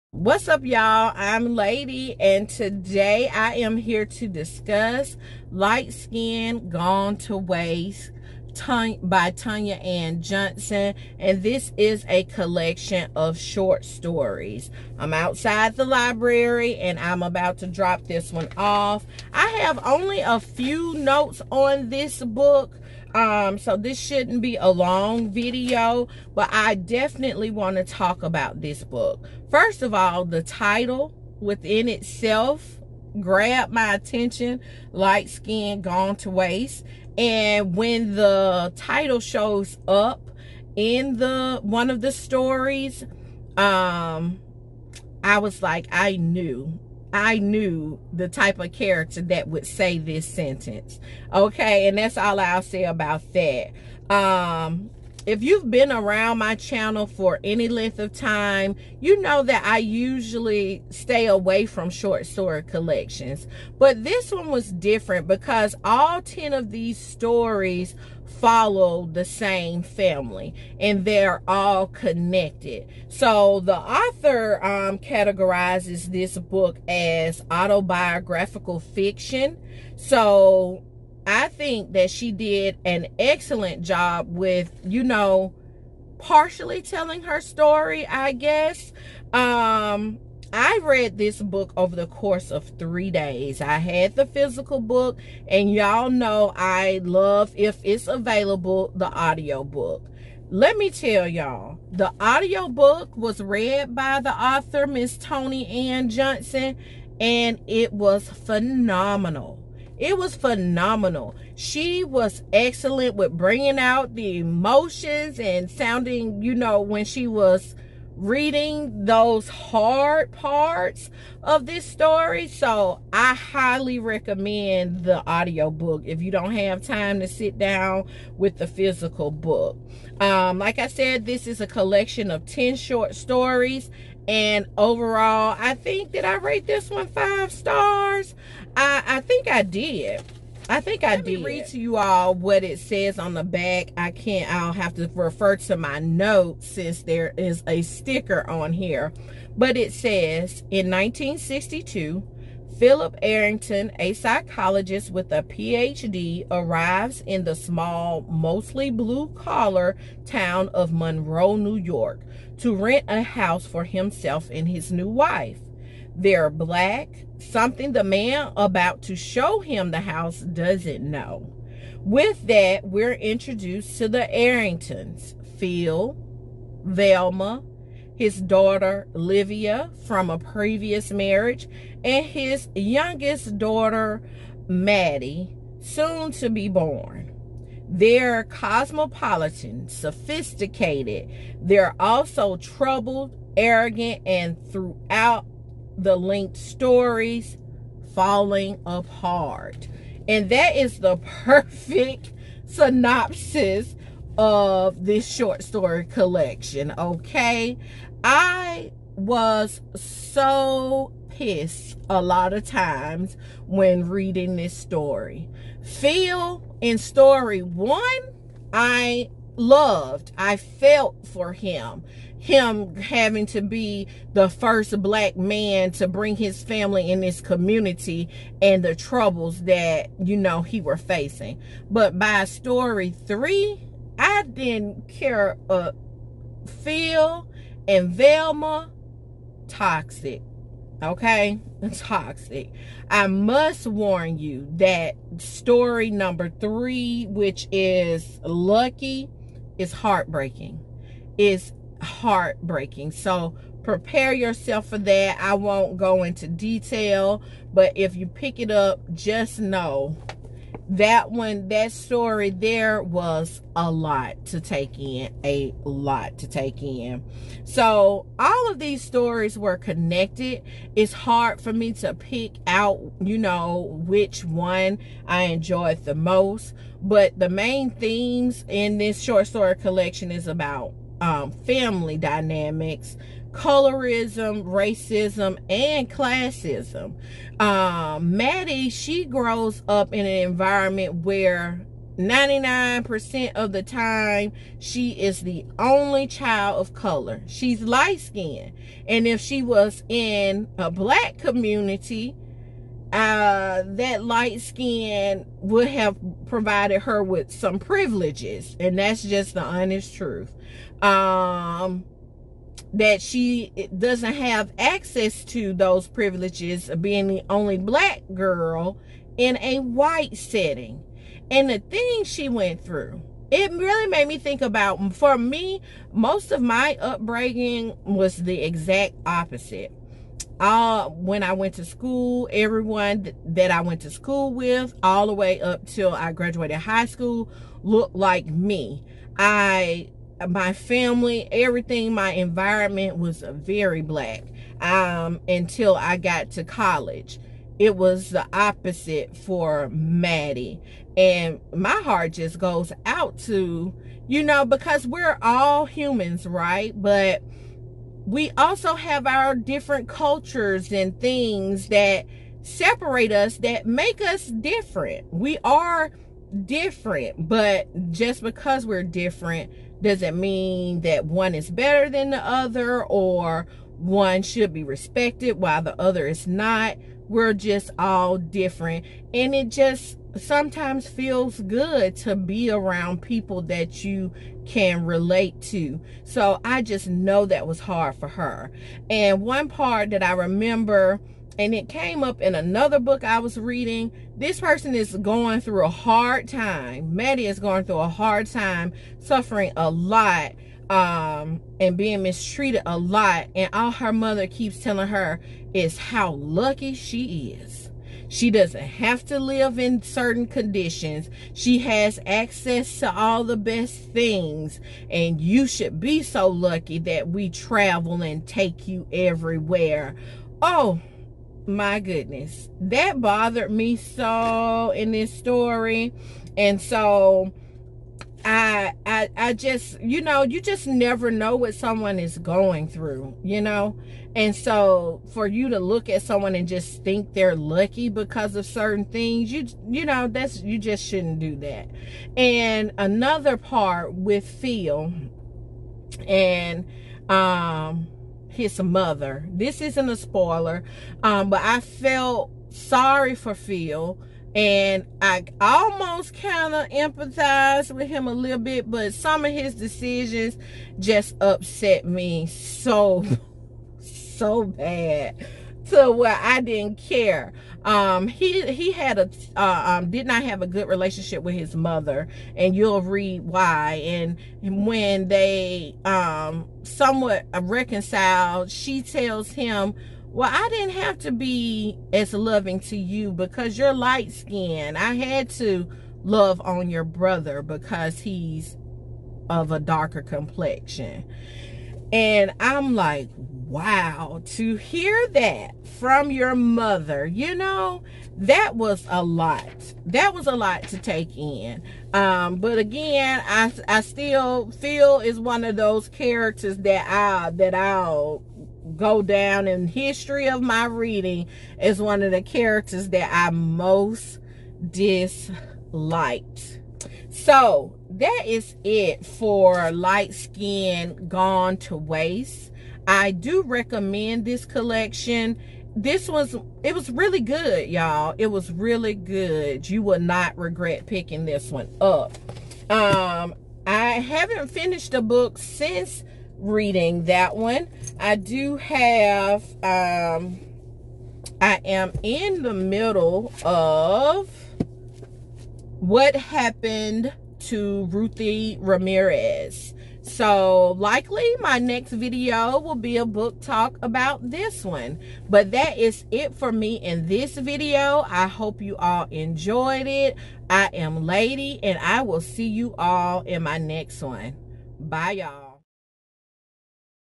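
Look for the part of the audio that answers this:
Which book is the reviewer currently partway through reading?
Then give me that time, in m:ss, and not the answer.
9:05.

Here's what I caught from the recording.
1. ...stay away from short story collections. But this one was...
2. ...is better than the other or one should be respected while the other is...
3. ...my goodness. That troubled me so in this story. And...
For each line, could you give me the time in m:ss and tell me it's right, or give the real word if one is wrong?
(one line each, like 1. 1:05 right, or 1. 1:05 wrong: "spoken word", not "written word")
1. 1:00 right
2. 6:11 right
3. 7:01 wrong: "bothered", not "troubled".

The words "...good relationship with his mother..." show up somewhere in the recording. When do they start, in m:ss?
7:50.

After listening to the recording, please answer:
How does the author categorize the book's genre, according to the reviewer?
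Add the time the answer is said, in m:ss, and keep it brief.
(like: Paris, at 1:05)
Autobiographical fiction, at 1:17.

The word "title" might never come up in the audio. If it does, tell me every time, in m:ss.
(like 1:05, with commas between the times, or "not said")
0:30, 0:38.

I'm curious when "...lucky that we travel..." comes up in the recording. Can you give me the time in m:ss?
6:56.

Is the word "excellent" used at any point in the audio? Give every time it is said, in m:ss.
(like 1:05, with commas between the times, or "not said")
1:23, 1:52.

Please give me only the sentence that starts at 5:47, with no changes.
It was the opposite for Maddie.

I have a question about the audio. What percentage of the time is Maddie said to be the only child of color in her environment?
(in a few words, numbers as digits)
99%.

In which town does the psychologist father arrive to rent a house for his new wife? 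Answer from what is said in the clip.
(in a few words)
Monroe, New York.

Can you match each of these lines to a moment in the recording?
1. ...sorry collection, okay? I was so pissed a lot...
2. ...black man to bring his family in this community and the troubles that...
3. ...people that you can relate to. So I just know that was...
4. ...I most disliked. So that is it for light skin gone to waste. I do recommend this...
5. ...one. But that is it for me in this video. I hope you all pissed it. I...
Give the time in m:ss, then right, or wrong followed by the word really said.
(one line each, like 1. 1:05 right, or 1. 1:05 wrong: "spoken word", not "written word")
1. 3:25 wrong: "story", not "sorry"
2. 3:45 right
3. 6:23 right
4. 8:33 right
5. 9:14 wrong: "enjoyed", not "pissed".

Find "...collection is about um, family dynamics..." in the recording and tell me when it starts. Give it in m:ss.
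4:39.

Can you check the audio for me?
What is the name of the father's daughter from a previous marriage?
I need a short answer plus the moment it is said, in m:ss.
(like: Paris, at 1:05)
Livia, at 2:59.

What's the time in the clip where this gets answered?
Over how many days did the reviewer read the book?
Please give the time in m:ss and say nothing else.
1:32.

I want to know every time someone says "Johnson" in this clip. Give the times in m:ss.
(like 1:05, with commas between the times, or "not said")
0:10, 1:46.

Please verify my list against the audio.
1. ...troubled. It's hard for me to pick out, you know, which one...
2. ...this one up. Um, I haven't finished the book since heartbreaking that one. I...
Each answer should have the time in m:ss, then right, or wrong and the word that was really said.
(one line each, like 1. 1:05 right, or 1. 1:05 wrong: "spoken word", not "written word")
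1. 4:29 wrong: "connected", not "troubled"
2. 8:51 wrong: "reading", not "heartbreaking".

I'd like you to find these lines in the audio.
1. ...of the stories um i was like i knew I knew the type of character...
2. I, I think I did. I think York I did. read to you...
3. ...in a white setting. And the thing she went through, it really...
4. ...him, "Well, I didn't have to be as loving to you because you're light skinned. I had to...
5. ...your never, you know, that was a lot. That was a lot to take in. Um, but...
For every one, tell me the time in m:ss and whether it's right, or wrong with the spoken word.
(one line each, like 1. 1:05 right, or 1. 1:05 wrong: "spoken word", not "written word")
1. 0:41 right
2. 2:18 wrong: "Let", not "York"
3. 5:19 right
4. 7:59 right
5. 8:16 wrong: "mother", not "never".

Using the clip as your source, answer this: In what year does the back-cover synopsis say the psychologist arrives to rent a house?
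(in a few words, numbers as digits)
1962.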